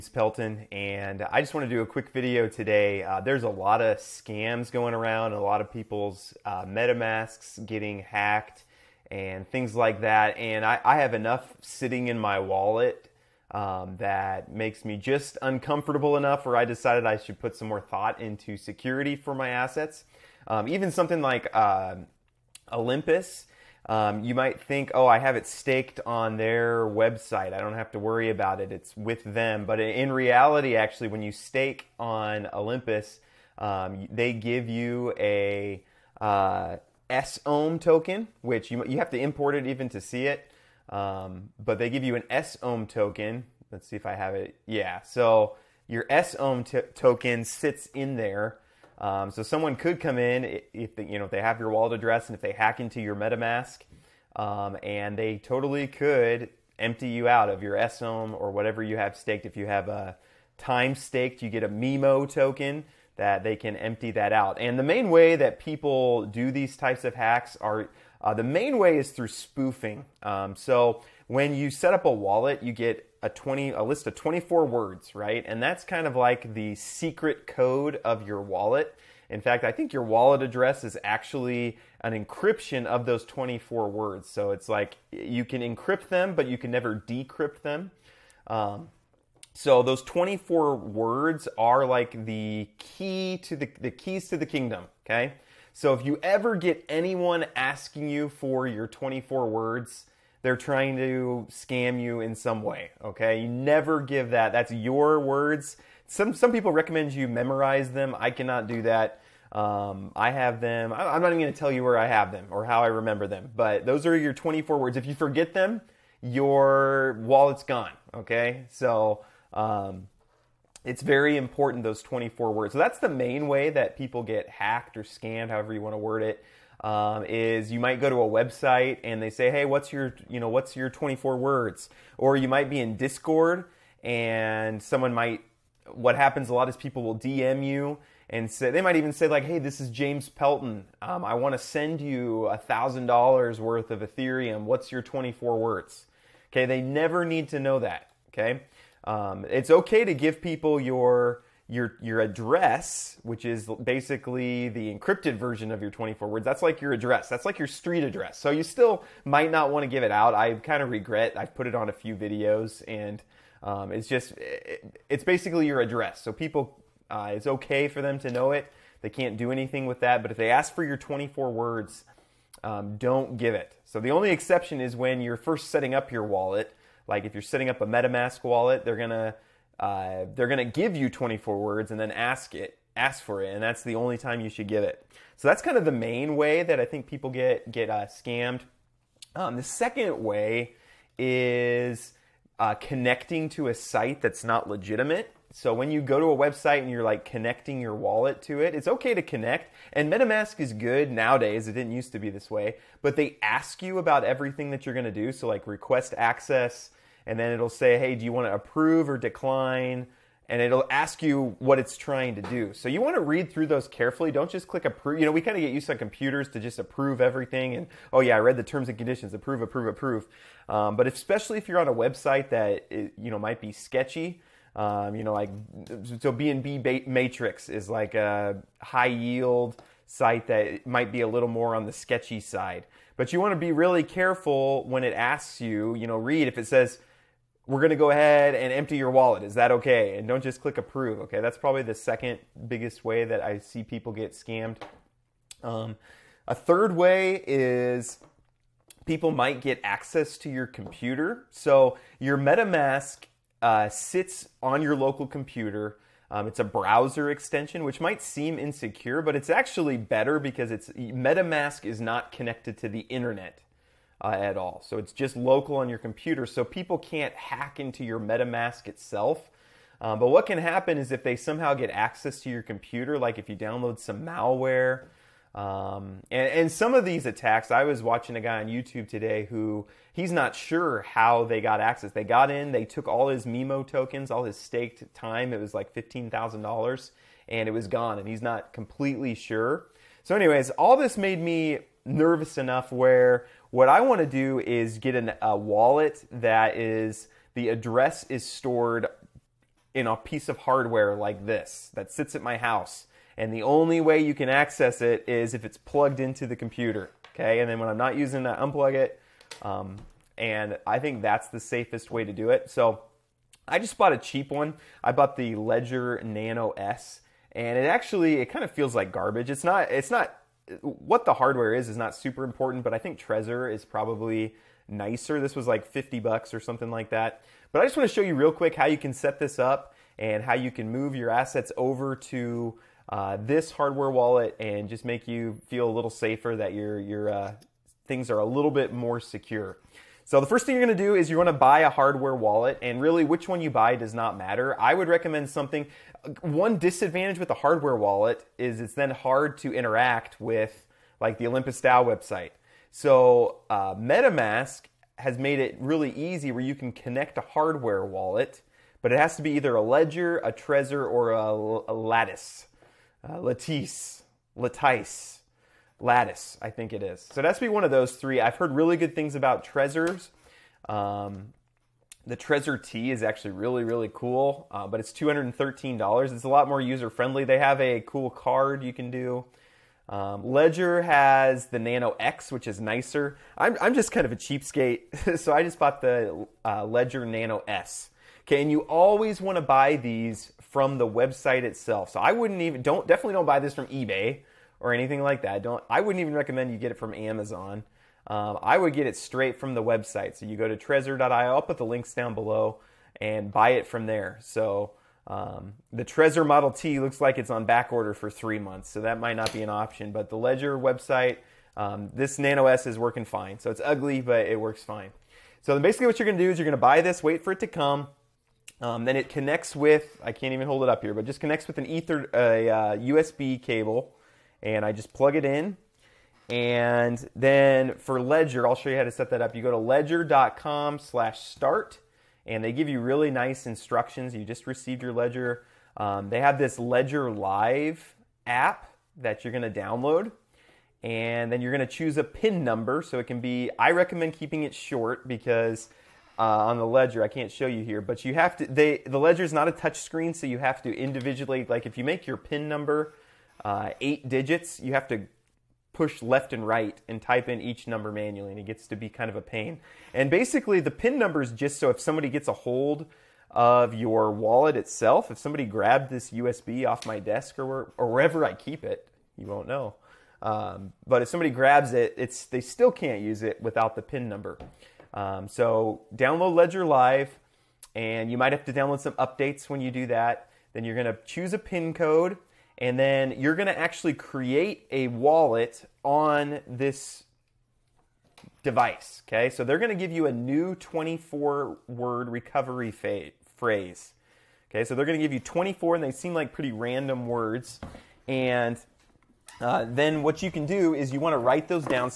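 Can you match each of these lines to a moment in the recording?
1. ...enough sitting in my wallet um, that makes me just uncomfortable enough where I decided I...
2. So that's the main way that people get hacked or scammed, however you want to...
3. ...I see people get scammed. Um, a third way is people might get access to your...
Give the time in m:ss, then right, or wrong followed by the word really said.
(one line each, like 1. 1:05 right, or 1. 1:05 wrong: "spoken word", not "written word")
1. 0:11 right
2. 2:02 right
3. 4:03 right.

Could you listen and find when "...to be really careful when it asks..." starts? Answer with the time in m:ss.
3:53.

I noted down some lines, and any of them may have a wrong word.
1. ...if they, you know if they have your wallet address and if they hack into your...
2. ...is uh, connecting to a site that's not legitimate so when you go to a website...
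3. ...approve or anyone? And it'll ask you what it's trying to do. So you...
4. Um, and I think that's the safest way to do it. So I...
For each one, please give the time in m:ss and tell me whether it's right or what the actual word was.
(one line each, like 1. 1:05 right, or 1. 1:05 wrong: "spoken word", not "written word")
1. 0:50 right
2. 3:11 right
3. 3:28 wrong: "decline", not "anyone"
4. 5:09 right.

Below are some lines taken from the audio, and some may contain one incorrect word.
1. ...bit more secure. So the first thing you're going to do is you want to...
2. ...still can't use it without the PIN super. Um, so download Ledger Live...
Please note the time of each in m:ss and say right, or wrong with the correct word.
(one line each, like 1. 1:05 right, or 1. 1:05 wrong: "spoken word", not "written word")
1. 5:38 right
2. 7:52 wrong: "number", not "super".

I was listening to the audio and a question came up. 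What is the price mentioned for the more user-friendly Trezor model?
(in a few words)
$213.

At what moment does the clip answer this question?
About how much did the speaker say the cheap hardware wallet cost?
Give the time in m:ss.
5:25.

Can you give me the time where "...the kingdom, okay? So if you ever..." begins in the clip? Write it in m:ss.
1:34.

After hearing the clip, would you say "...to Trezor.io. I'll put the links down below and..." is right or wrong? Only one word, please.
right.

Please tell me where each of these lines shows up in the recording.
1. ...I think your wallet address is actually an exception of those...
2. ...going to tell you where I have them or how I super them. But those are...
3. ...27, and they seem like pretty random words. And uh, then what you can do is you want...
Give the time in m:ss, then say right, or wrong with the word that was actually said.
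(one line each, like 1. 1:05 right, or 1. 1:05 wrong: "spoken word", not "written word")
1. 1:19 wrong: "encryption", not "exception"
2. 1:51 wrong: "remember", not "super"
3. 8:15 wrong: "24", not "27".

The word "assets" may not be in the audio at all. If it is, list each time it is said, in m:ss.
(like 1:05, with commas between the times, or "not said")
0:19, 5:31.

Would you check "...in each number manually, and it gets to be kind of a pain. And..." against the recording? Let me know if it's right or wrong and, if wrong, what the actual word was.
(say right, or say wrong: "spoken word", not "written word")
right.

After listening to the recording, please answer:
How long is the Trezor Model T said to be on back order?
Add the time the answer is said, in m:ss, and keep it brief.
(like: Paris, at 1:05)
three months, at 6:48.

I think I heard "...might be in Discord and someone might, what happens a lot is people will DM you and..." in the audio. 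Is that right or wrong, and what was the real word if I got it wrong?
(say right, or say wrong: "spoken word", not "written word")
right.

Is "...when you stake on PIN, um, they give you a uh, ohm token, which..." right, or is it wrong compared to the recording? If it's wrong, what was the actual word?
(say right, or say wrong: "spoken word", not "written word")
wrong: "Olympus", not "PIN".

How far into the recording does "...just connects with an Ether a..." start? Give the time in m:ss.
7:01.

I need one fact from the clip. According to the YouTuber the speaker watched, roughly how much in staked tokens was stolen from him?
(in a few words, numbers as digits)
$15,000.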